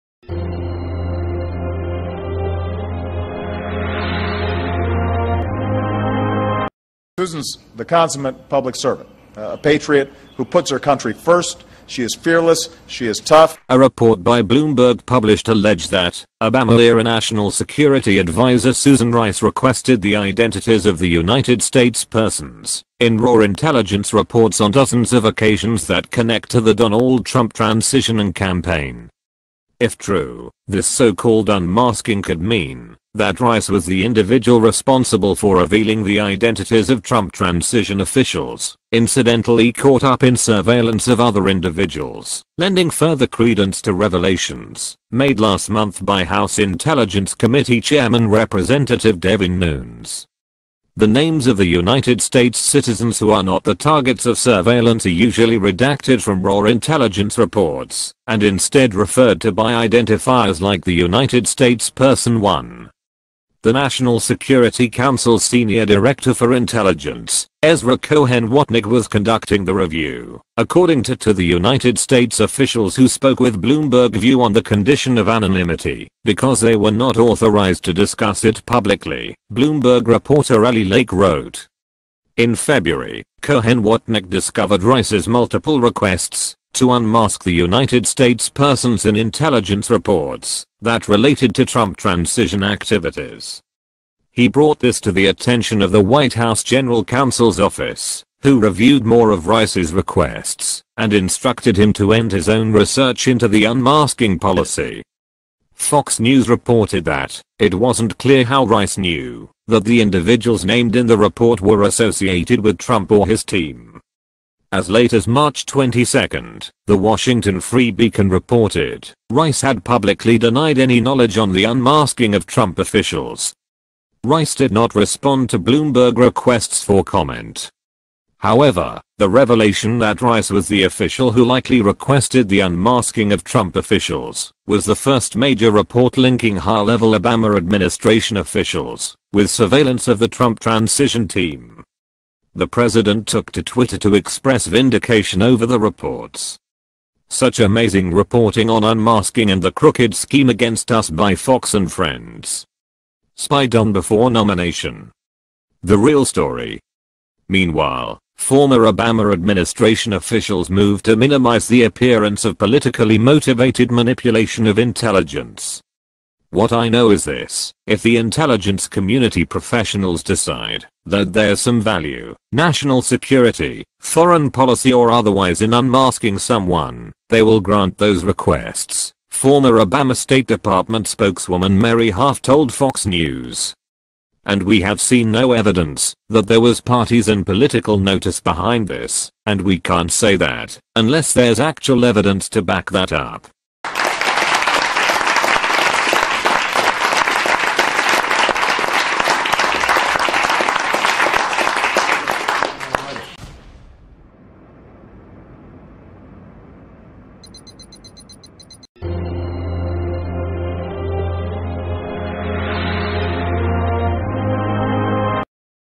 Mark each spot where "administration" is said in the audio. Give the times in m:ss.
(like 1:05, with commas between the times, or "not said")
2:17, 2:39.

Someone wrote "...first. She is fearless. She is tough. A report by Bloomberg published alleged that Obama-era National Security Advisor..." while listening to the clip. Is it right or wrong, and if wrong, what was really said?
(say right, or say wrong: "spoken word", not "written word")
right.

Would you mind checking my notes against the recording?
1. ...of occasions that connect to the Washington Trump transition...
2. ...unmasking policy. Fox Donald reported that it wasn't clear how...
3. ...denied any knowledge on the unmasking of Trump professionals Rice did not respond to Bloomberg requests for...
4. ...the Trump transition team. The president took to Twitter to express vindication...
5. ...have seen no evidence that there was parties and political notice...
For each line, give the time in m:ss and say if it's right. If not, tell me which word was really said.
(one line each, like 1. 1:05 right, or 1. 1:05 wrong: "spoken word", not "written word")
1. 0:25 wrong: "Donald", not "Washington"
2. 1:43 wrong: "News", not "Donald"
3. 2:00 wrong: "officials", not "professionals"
4. 2:20 right
5. 3:04 right.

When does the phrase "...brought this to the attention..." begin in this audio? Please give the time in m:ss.
1:34.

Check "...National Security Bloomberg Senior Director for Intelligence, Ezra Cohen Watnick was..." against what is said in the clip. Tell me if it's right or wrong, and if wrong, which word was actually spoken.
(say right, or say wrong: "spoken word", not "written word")
wrong: "Council", not "Bloomberg".